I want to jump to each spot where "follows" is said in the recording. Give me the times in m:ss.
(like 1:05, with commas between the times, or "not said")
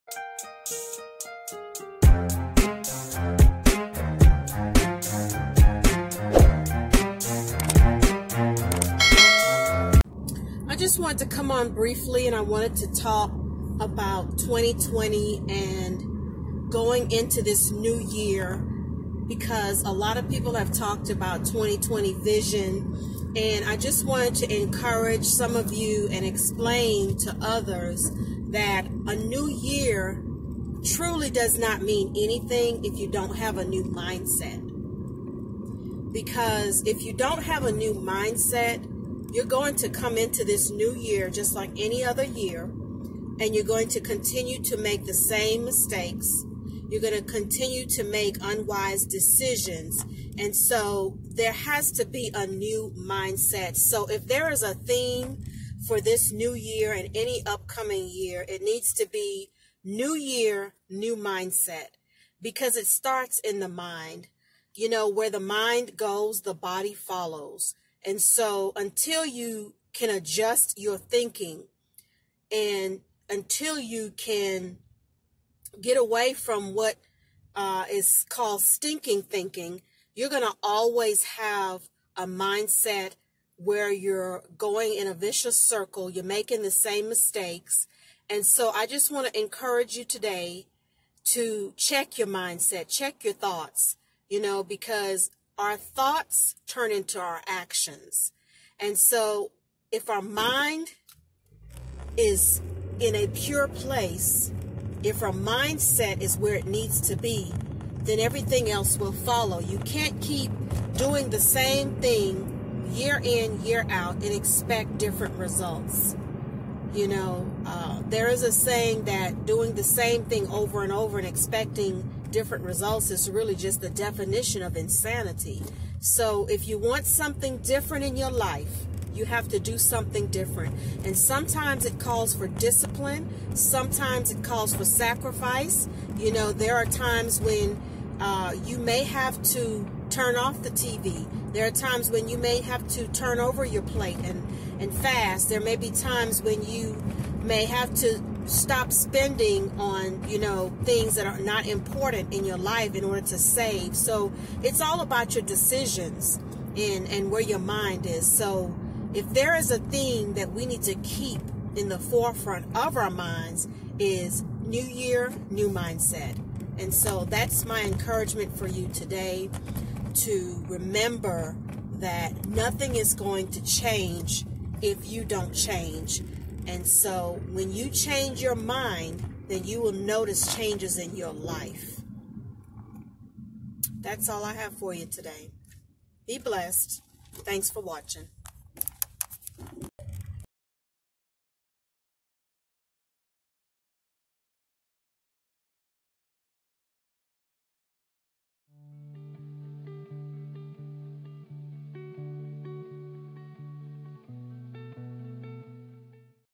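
1:06, 1:49.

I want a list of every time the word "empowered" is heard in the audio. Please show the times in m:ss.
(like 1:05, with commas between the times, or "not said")
not said.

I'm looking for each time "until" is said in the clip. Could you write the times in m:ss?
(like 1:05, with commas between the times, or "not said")
1:08, 1:13.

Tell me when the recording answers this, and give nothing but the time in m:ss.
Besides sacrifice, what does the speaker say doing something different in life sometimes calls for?
2:12.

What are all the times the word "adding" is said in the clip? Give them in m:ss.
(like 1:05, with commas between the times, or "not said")
not said.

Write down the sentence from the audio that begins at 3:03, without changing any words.
That's all I have for you today.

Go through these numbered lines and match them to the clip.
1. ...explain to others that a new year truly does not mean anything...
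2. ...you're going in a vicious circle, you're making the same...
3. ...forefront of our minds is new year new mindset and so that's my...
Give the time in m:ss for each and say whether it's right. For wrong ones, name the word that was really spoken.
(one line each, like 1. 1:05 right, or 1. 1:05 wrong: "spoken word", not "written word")
1. 0:26 right
2. 1:23 right
3. 2:41 right.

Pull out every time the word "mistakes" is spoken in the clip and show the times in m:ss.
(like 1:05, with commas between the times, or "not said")
0:45, 1:27.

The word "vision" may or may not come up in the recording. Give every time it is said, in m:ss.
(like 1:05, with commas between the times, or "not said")
0:22.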